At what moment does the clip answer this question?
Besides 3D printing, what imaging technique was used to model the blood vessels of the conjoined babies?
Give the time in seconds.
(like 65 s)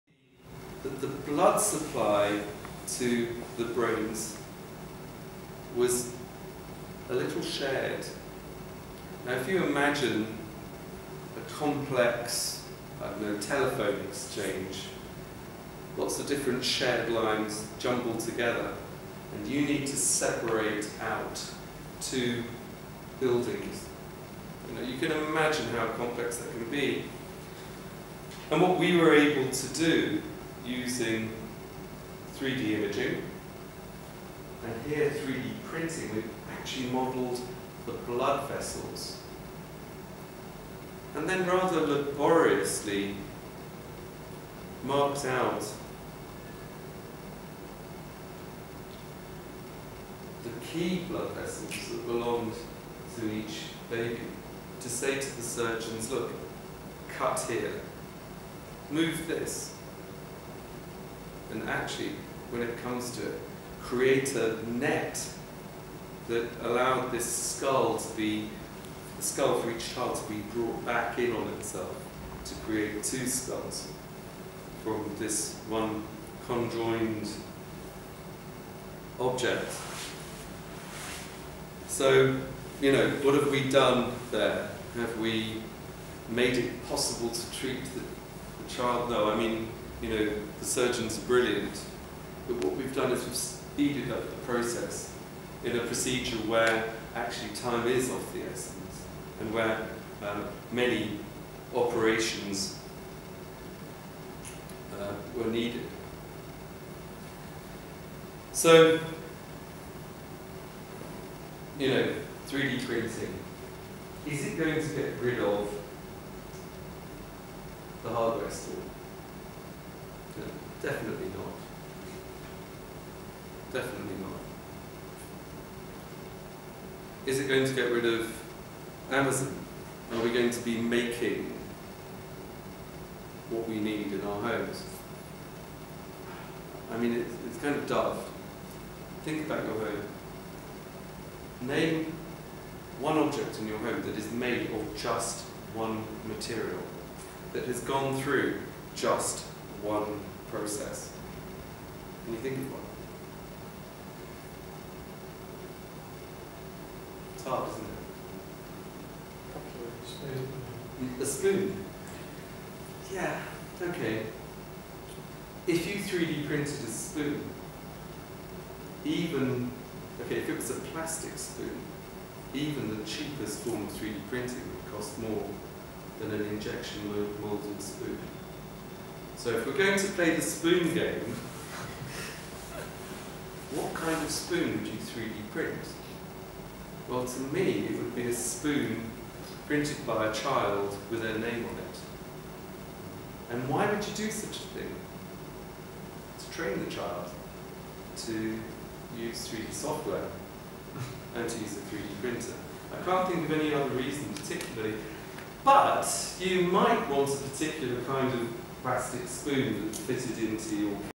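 32 s.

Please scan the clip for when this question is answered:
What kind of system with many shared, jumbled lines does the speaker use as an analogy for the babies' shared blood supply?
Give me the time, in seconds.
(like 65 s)
13 s.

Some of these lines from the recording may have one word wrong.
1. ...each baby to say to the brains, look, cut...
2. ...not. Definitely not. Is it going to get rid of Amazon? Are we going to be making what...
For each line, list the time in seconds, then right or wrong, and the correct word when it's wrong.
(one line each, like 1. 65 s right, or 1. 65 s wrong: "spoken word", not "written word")
1. 53 s wrong: "surgeons", not "brains"
2. 121 s right.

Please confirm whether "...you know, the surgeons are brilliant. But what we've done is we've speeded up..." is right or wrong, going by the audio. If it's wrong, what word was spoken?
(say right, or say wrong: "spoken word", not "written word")
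right.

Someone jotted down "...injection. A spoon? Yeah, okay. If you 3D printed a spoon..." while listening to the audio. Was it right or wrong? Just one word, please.
wrong.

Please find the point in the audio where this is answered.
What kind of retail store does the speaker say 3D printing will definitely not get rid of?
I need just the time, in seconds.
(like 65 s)
118 s.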